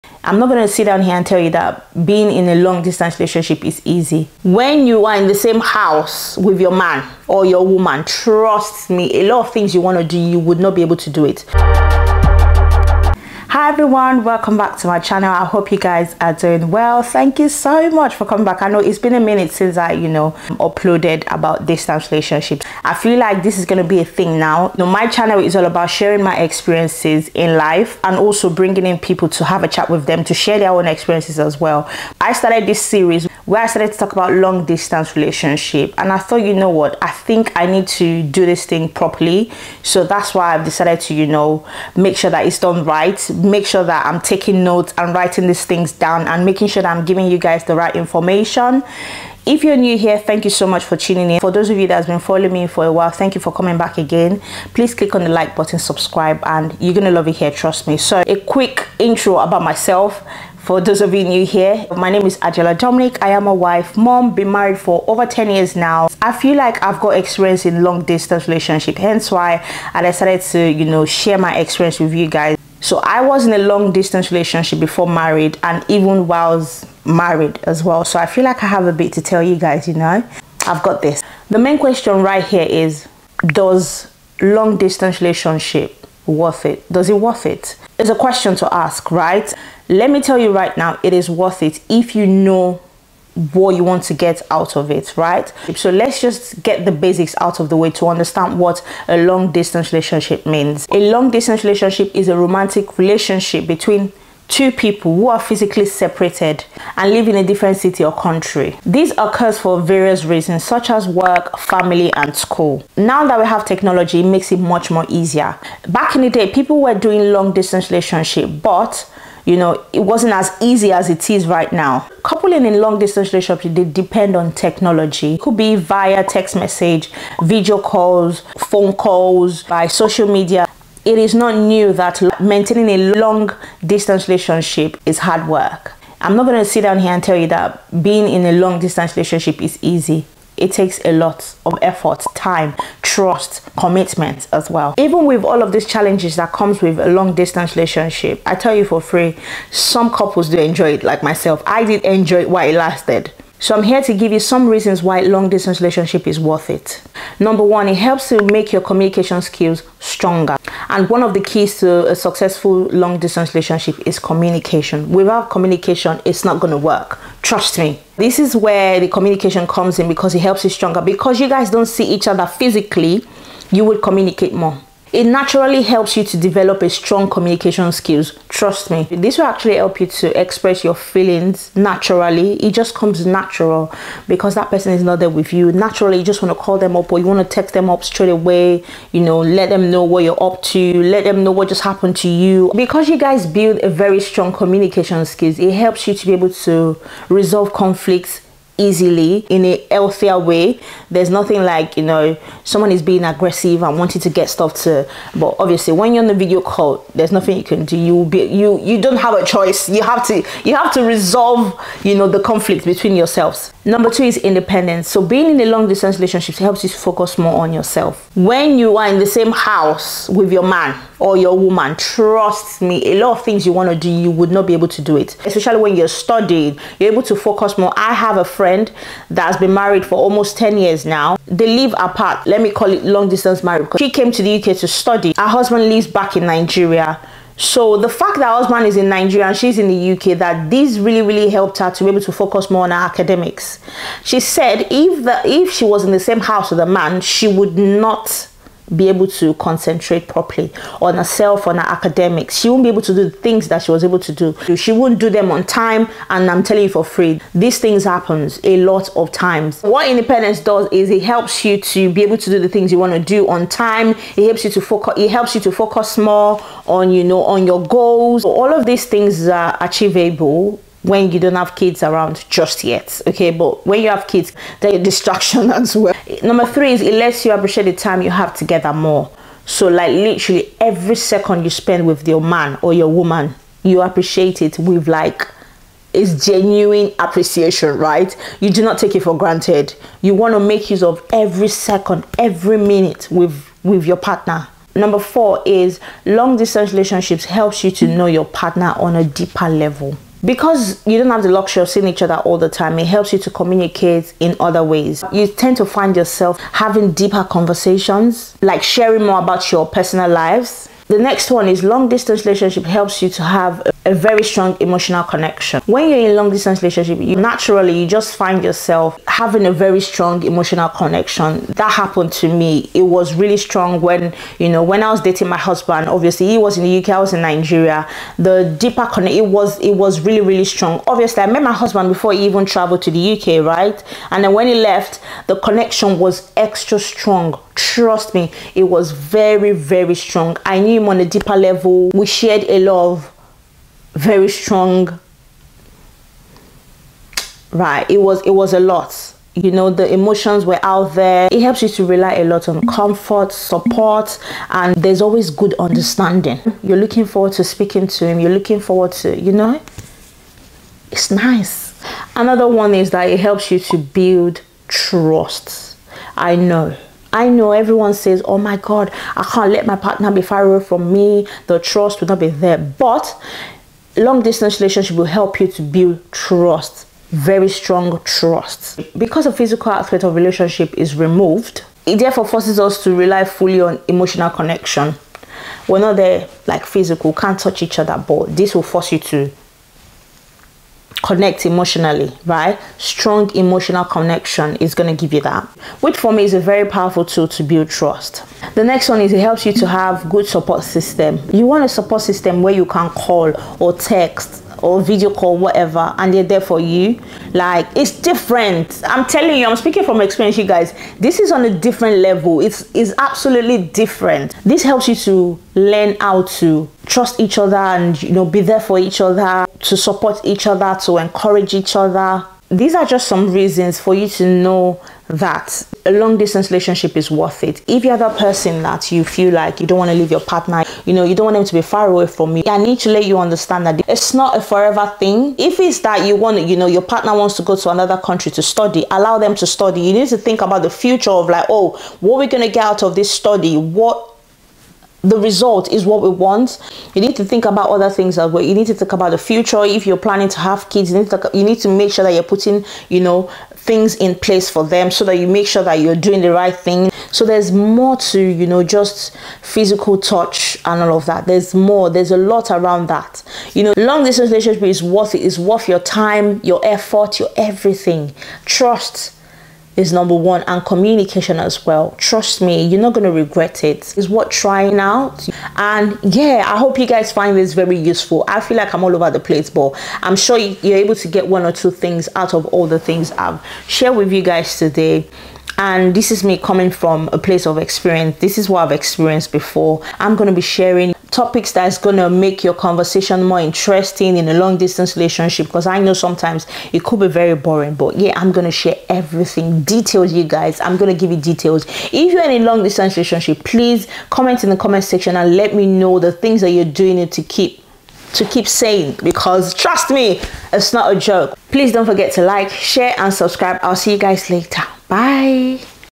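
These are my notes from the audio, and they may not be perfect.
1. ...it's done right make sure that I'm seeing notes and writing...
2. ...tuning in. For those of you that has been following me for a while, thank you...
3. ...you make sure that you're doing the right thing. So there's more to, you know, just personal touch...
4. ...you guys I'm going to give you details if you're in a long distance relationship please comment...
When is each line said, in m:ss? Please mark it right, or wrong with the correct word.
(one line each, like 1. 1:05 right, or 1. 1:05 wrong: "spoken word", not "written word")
1. 0:42 wrong: "taking", not "seeing"
2. 0:50 right
3. 7:35 wrong: "physical", not "personal"
4. 8:20 right.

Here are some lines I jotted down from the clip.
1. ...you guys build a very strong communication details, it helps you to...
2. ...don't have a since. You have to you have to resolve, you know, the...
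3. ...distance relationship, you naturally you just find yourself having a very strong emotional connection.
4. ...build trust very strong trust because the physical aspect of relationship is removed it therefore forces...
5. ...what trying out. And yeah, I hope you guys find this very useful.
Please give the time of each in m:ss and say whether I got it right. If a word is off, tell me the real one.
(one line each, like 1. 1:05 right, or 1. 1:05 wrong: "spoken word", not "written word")
1. 3:13 wrong: "skills", not "details"
2. 3:28 wrong: "choice", not "since"
3. 5:16 right
4. 6:15 right
5. 7:54 right.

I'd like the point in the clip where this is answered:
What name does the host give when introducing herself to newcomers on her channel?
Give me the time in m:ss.
1:02.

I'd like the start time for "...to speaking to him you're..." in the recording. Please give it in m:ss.
5:57.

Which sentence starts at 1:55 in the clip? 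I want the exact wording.
Back in the day, people were doing long distance relationship, but you know, it wasn't as easy as it is right now.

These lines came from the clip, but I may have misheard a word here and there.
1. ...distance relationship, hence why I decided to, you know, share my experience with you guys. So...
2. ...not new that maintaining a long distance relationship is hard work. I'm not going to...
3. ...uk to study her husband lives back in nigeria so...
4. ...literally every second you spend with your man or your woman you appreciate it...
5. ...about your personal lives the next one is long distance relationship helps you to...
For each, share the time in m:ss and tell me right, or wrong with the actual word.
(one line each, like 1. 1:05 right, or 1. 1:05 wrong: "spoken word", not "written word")
1. 1:08 right
2. 2:11 right
3. 3:54 right
4. 4:40 right
5. 5:09 right.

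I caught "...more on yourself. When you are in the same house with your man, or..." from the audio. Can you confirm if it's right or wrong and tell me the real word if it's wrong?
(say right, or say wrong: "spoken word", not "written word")
right.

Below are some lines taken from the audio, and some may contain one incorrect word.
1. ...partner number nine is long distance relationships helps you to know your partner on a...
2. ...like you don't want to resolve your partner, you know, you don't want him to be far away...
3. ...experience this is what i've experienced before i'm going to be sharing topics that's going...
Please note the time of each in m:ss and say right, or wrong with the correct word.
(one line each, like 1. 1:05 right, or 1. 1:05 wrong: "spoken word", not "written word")
1. 4:54 wrong: "four", not "nine"
2. 7:09 wrong: "leave", not "resolve"
3. 8:07 right.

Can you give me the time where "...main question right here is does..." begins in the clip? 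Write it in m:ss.
1:21.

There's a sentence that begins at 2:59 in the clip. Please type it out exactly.
This will actually help you to express your feelings naturally.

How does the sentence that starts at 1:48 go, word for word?
This occurs for various reasons such as work, family and school.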